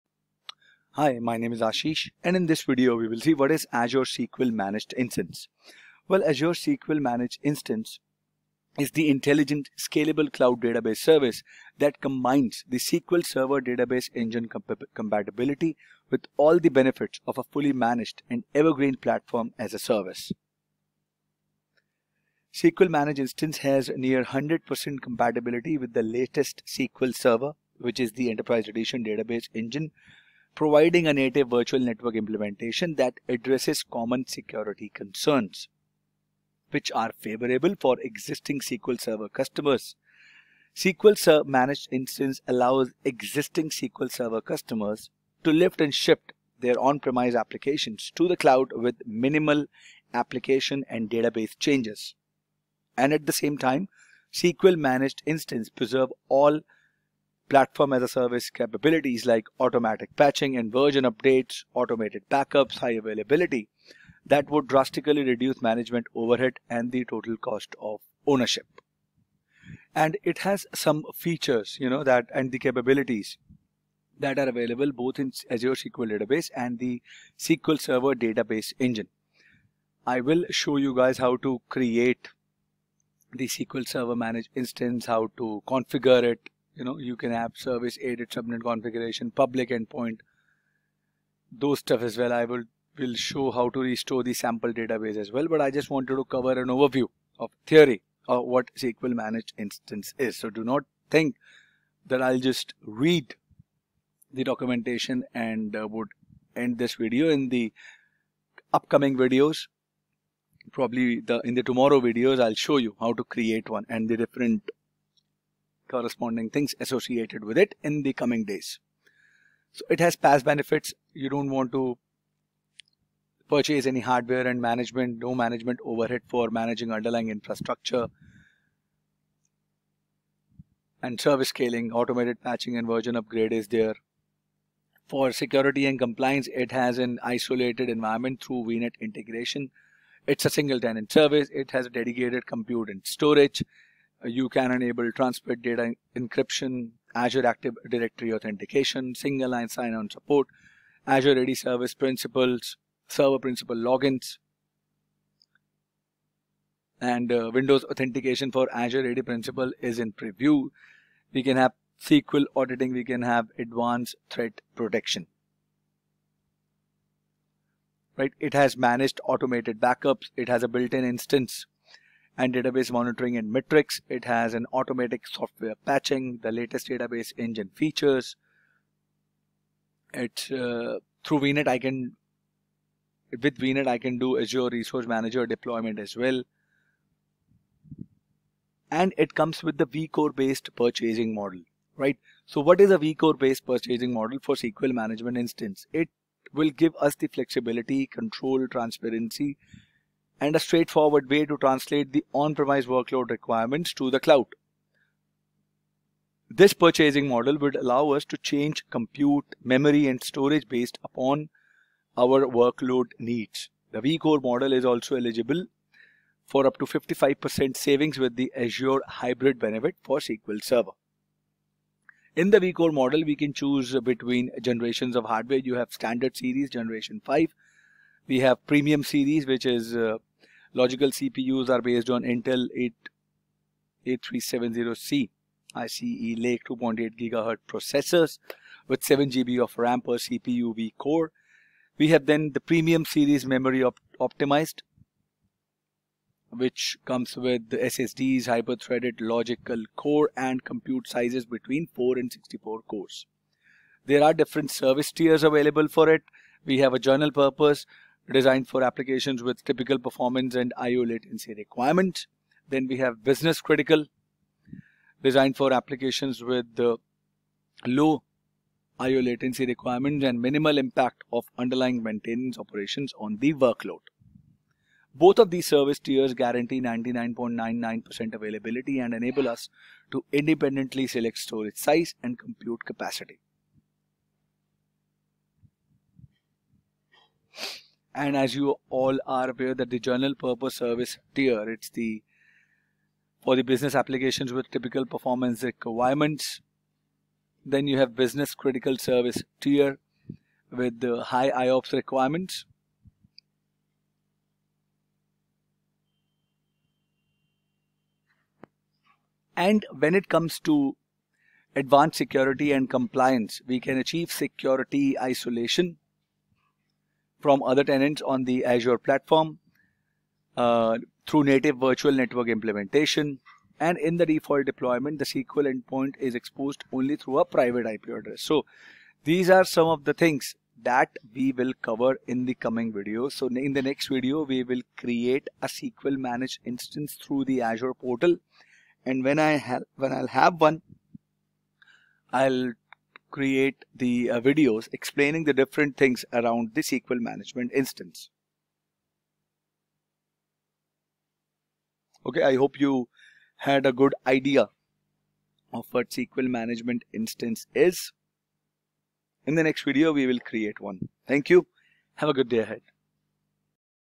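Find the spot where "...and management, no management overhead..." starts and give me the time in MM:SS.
02:04.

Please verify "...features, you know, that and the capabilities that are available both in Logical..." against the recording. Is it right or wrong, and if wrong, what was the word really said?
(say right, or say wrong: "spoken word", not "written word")
wrong: "Azure", not "Logical".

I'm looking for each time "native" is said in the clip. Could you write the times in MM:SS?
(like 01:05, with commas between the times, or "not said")
00:31, 05:21.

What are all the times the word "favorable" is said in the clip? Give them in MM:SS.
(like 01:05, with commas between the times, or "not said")
00:37.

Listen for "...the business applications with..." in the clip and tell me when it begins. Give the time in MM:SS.
04:53.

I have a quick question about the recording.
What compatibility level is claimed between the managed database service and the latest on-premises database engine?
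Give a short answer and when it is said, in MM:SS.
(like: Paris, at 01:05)
near 100%, at 00:23.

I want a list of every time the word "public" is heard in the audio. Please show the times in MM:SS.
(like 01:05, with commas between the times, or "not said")
01:29.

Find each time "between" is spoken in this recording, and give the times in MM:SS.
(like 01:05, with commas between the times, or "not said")
03:44, 04:11.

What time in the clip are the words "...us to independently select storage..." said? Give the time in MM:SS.
04:39.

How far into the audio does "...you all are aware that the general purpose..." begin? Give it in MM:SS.
04:48.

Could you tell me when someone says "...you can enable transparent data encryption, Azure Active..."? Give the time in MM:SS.
02:24.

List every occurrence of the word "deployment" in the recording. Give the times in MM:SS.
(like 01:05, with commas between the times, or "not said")
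03:05, 05:24.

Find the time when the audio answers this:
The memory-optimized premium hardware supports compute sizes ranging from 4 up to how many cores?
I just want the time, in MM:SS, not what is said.
04:12.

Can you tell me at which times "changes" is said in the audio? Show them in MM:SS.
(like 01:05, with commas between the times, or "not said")
00:51, 03:28.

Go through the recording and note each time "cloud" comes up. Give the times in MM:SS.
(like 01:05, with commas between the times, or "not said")
00:10, 00:48, 03:24.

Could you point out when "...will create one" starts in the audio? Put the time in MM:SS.
06:00.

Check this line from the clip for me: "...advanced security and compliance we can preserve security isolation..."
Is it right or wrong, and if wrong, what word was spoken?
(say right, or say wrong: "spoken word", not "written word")
wrong: "achieve", not "preserve".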